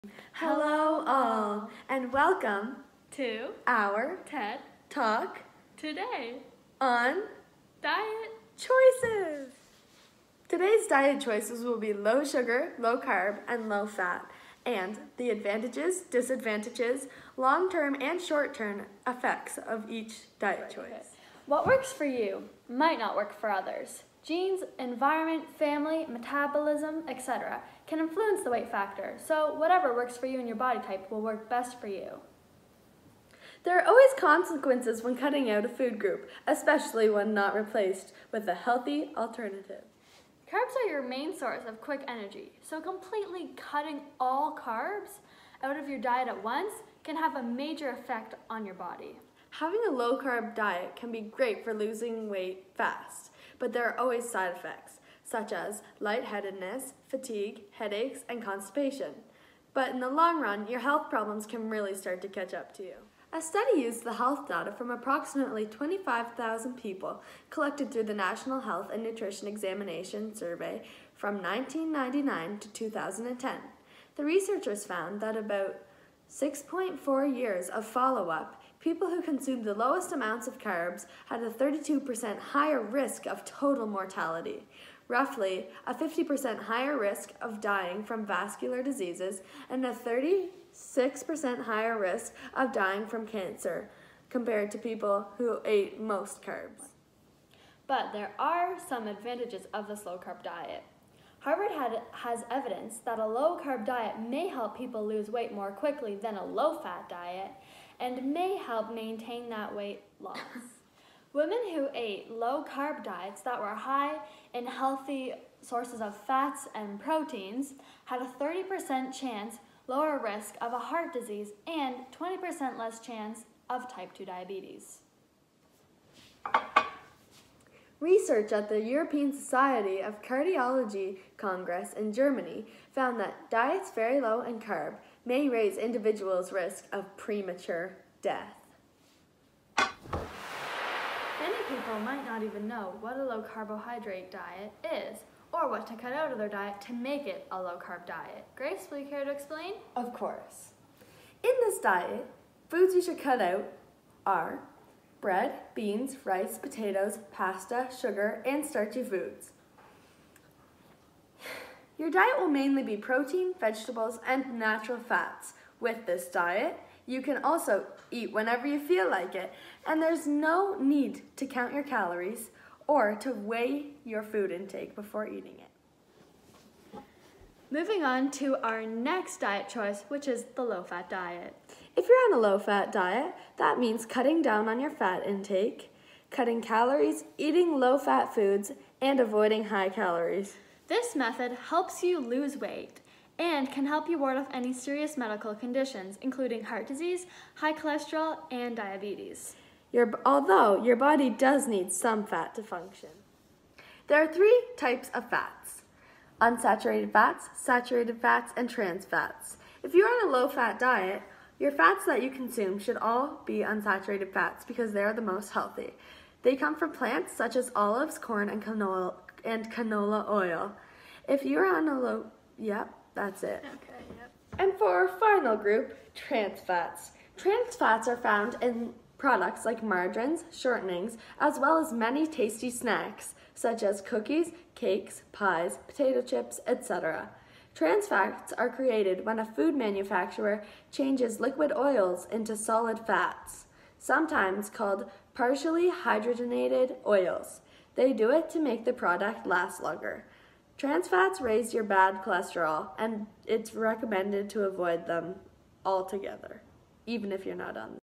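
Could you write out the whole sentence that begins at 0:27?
can influence the weight factor, so whatever works for you and your body type will work best for you.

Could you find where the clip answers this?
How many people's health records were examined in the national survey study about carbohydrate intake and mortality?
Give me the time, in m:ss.
1:05.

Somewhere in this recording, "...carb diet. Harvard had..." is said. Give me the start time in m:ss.
1:40.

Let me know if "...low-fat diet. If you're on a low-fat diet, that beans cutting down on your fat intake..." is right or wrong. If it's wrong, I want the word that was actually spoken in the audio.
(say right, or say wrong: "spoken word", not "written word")
wrong: "means", not "beans".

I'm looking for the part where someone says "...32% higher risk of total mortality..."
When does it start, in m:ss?
1:21.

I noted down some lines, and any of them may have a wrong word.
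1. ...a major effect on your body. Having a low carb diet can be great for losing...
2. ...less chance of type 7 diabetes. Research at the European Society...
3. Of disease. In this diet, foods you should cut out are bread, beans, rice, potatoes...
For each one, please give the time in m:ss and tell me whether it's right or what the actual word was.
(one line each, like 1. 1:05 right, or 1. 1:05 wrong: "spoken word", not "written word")
1. 0:47 right
2. 2:02 wrong: "2", not "7"
3. 2:29 wrong: "course", not "disease".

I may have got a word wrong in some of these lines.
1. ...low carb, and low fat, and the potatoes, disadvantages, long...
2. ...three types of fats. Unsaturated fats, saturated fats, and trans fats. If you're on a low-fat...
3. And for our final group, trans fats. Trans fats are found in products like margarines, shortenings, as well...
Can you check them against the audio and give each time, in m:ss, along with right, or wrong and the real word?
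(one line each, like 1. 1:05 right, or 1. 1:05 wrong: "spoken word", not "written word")
1. 0:12 wrong: "advantages", not "potatoes"
2. 3:24 right
3. 3:44 right.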